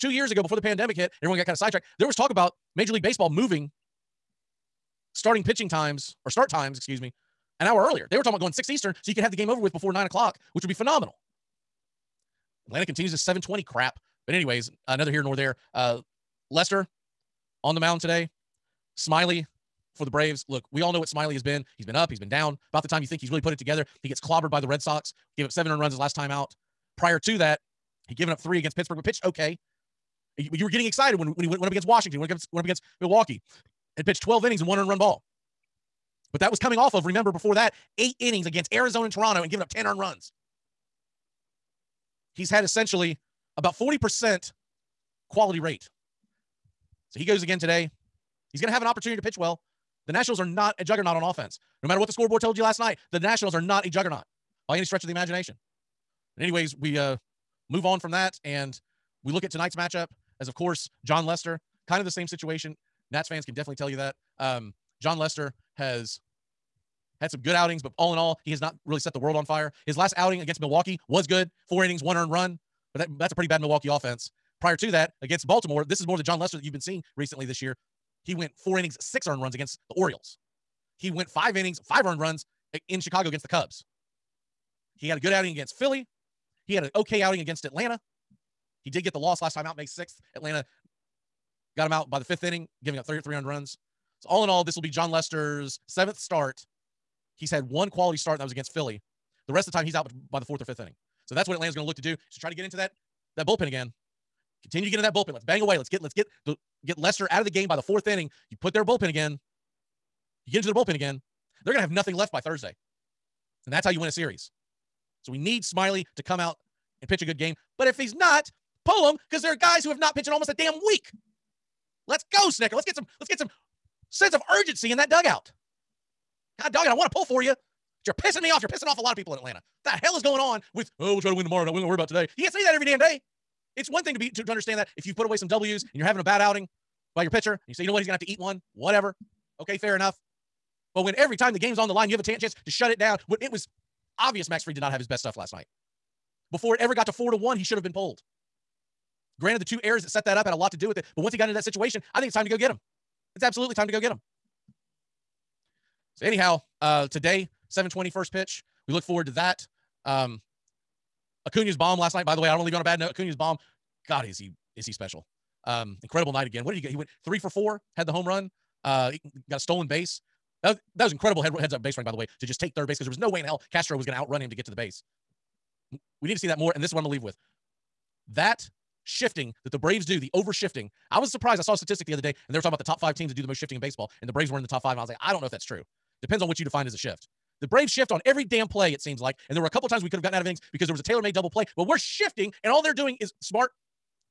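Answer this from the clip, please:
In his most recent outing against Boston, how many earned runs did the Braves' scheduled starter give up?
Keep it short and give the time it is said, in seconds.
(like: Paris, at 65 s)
7, at 25 s.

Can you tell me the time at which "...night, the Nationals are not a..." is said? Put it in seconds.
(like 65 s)
52 s.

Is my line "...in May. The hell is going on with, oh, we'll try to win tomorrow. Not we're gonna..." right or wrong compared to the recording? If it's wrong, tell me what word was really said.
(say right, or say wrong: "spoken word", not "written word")
wrong: "Atlanta", not "May".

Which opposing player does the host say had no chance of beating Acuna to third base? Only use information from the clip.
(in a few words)
Castro.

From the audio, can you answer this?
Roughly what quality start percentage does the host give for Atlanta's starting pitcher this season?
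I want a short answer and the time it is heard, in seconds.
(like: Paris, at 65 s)
40%, at 43 s.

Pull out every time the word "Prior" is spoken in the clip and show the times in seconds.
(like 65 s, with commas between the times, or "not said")
26 s, 74 s.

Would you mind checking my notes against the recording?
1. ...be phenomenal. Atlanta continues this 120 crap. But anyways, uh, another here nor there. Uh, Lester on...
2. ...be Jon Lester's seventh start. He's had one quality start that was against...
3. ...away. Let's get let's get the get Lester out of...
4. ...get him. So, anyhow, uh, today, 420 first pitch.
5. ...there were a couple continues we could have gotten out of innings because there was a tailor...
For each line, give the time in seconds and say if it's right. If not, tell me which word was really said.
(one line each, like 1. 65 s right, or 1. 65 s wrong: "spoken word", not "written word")
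1. 10 s wrong: "720", not "120"
2. 94 s right
3. 105 s right
4. 153 s wrong: "720", not "420"
5. 189 s wrong: "times", not "continues".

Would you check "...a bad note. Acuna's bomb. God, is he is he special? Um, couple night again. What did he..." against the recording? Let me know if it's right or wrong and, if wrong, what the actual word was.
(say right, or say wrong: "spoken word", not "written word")
wrong: "incredible", not "couple".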